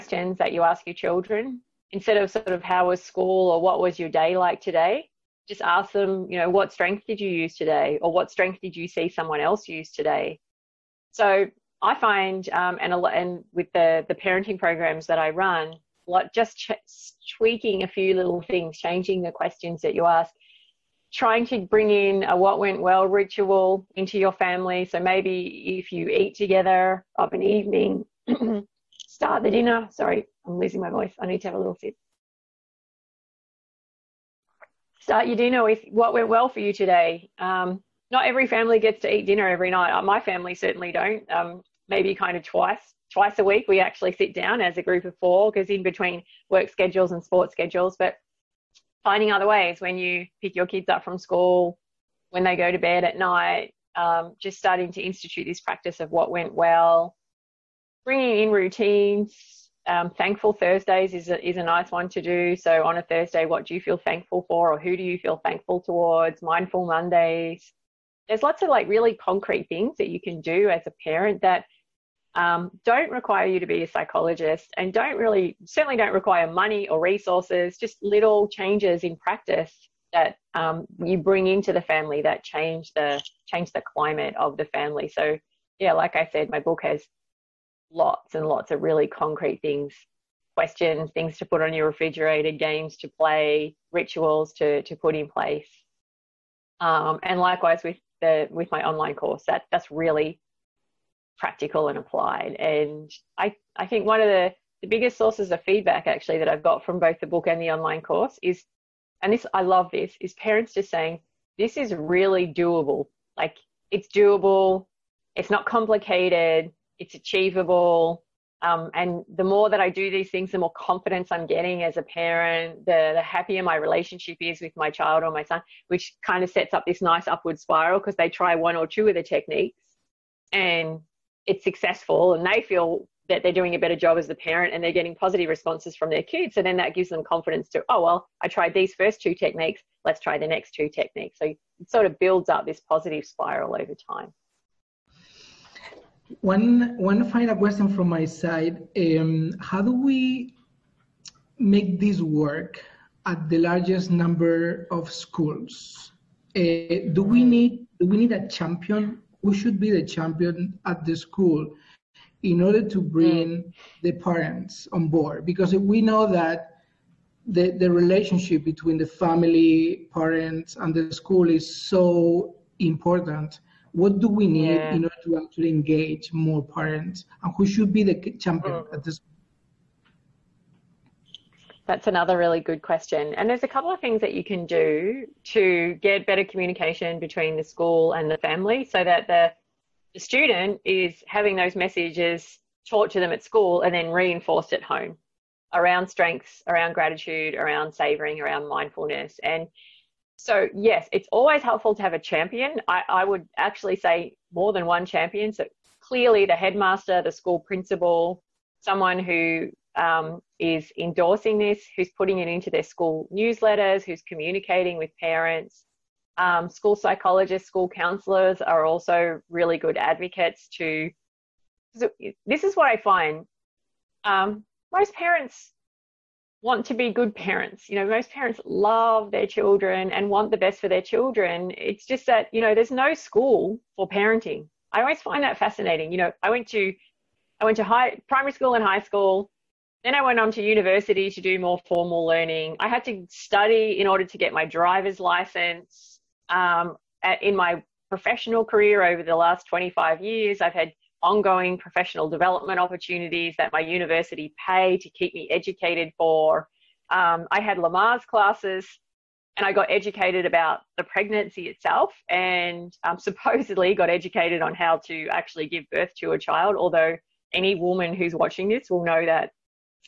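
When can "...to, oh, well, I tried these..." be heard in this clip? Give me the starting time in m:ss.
2:17.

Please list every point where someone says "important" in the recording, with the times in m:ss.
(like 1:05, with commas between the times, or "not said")
2:52.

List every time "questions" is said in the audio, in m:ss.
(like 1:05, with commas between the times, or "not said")
0:19, 1:30, 2:27, 3:02.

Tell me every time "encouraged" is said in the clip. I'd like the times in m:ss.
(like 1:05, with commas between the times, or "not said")
not said.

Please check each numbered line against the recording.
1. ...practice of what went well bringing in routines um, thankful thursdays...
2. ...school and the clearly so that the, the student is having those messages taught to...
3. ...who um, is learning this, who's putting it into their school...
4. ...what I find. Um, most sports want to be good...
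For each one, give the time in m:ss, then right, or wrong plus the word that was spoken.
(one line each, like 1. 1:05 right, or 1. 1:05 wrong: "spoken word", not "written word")
1. 0:55 right
2. 3:07 wrong: "family", not "clearly"
3. 3:29 wrong: "endorsing", not "learning"
4. 3:42 wrong: "parents", not "sports".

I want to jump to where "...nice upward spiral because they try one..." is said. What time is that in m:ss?
2:07.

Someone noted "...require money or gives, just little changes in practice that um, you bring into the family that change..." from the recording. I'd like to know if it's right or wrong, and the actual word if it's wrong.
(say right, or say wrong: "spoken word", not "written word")
wrong: "resources", not "gives".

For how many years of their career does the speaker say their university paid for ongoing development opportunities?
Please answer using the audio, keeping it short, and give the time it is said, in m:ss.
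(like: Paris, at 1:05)
25, at 4:09.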